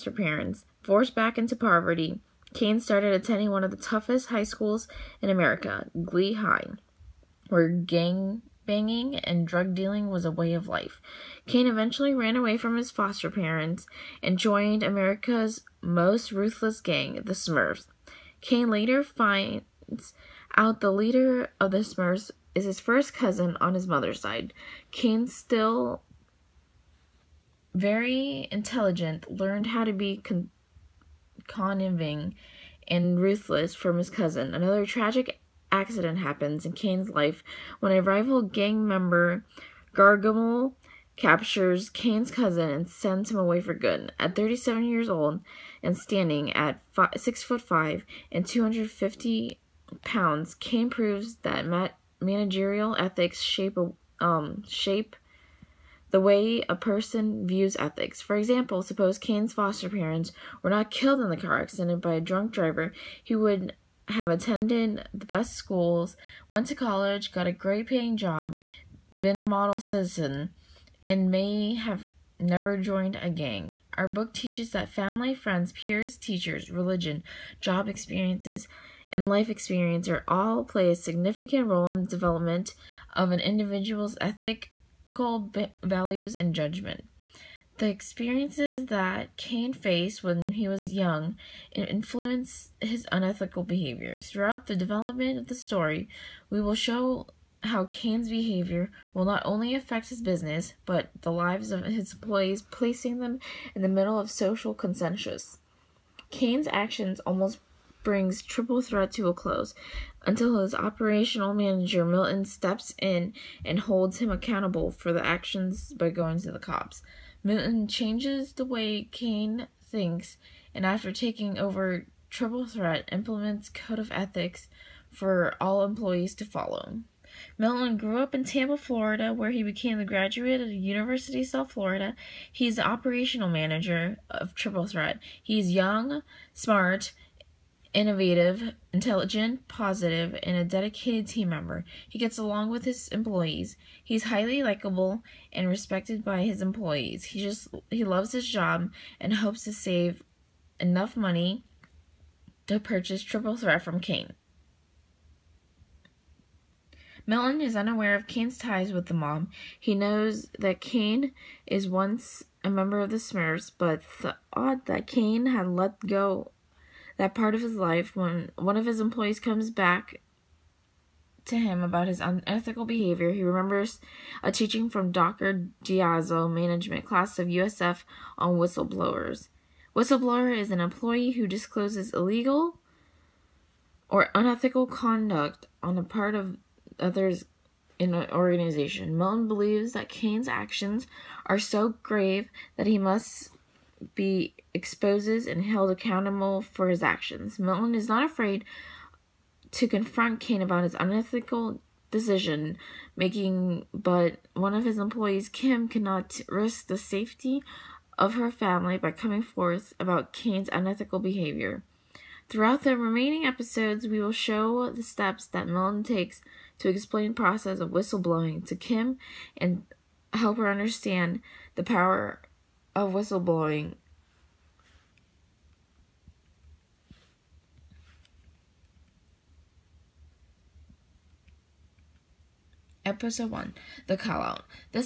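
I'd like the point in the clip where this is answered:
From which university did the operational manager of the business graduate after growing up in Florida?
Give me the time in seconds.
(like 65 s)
130 s.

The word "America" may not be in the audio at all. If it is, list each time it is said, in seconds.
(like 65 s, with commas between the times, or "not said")
5 s, 14 s.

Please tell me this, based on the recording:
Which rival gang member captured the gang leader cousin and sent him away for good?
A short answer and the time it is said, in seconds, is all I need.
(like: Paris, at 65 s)
Gargamel, at 39 s.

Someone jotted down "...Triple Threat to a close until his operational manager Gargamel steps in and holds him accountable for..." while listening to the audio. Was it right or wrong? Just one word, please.
wrong.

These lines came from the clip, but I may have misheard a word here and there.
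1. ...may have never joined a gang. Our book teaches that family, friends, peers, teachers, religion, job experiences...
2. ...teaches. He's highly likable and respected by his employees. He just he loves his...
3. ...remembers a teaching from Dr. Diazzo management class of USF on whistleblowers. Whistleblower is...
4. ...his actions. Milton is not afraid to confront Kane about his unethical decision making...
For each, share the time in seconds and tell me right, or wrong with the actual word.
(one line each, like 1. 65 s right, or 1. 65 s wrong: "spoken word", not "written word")
1. 71 s right
2. 143 s wrong: "employees", not "teaches"
3. 173 s right
4. 196 s right.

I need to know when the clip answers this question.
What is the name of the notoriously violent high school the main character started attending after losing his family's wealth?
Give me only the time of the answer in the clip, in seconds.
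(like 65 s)
6 s.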